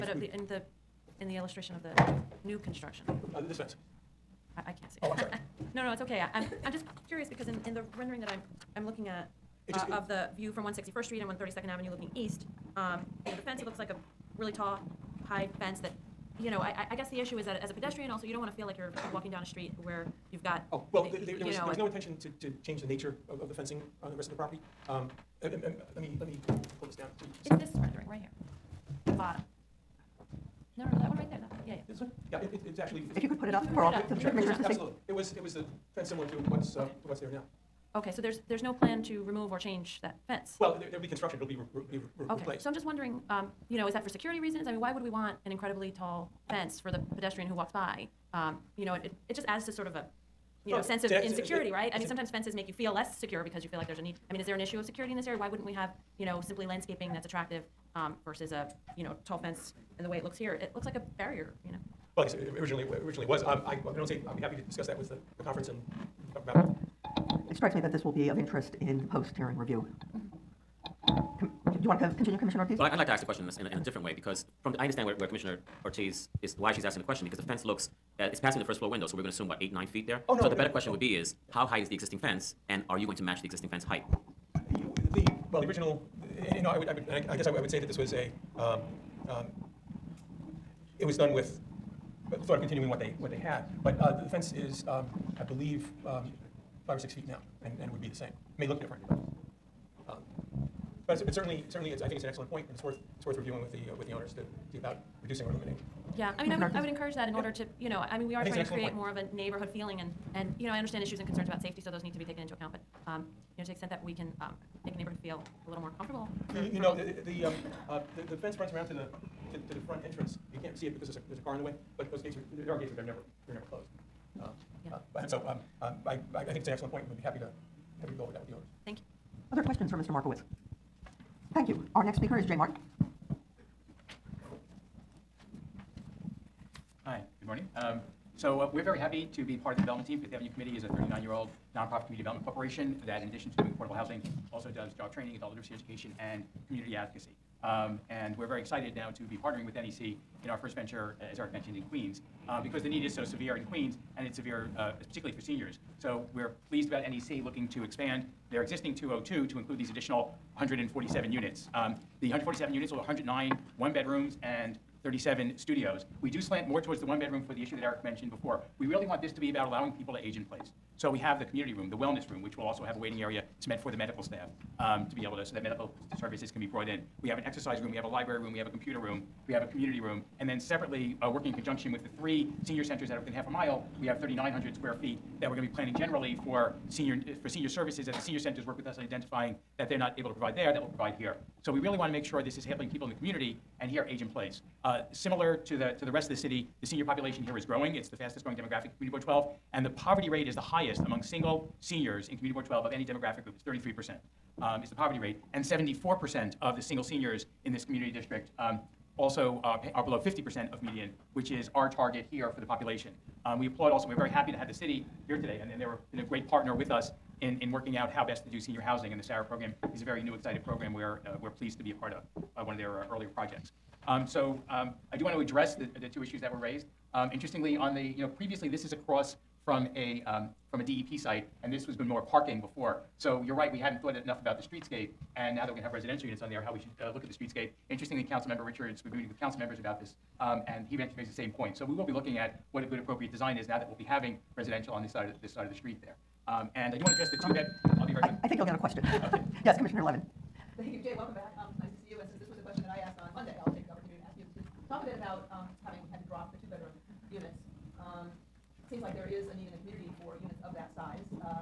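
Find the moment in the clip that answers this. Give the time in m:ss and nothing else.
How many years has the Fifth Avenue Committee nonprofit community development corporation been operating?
2:20.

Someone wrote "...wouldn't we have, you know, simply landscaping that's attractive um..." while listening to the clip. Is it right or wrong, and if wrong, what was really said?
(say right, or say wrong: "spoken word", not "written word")
right.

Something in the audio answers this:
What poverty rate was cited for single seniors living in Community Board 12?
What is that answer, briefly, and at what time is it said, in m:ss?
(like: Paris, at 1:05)
33 percent, at 3:23.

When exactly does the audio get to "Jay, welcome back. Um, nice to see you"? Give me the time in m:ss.
4:11.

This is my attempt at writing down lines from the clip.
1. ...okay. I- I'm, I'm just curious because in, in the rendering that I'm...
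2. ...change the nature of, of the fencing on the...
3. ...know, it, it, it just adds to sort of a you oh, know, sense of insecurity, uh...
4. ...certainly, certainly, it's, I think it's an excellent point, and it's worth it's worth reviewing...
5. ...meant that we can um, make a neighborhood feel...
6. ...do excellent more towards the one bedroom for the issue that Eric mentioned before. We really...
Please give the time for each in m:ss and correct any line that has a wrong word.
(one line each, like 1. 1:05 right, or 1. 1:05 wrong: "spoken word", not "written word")
1. 0:06 right
2. 0:22 right
3. 0:48 right
4. 1:41 right
5. 1:53 wrong: "extent", not "meant"
6. 2:46 wrong: "slant", not "excellent".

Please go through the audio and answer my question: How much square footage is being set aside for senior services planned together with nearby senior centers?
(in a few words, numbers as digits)
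3,900 square feet.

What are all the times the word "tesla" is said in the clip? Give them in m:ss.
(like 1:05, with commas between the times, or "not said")
not said.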